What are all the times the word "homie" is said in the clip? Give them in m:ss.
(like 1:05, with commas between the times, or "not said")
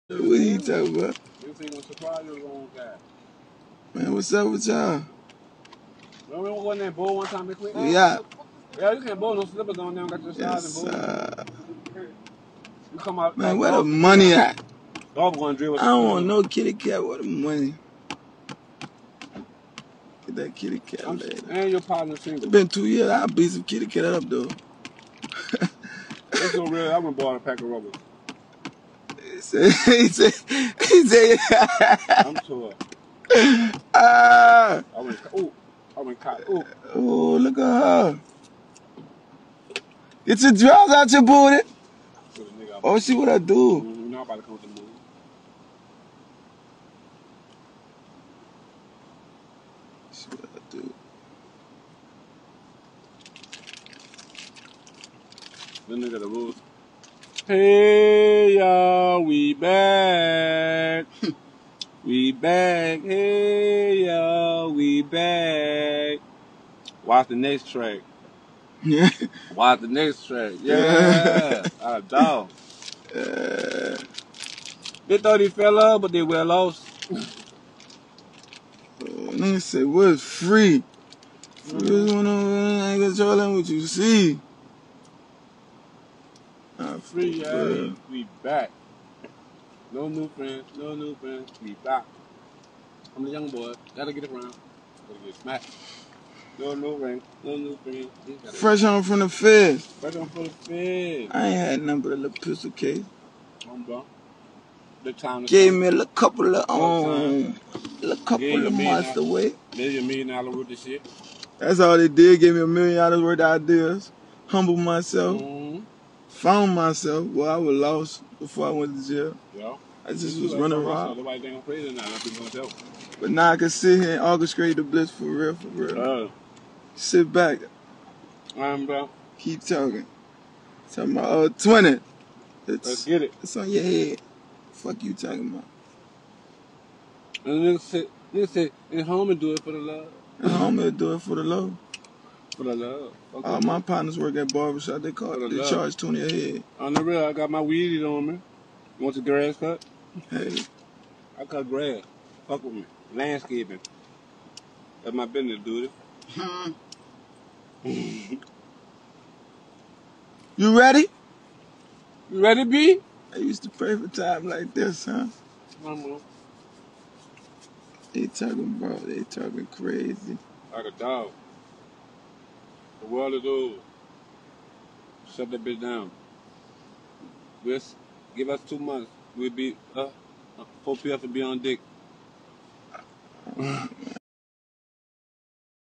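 2:20.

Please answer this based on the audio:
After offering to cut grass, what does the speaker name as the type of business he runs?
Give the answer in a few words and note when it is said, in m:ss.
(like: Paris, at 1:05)
Landscaping, at 2:33.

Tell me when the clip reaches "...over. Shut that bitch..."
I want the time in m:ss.
2:53.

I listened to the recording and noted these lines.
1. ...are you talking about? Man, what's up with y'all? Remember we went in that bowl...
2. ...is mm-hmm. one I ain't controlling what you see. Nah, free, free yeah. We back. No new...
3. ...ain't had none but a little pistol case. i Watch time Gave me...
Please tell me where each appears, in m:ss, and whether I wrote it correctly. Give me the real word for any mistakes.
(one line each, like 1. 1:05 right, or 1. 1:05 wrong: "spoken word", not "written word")
1. 0:00 right
2. 1:21 right
3. 1:41 wrong: "The", not "Watch".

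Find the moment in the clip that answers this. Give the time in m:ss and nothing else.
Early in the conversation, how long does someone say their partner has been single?
0:22.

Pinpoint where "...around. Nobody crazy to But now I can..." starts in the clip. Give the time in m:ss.
2:00.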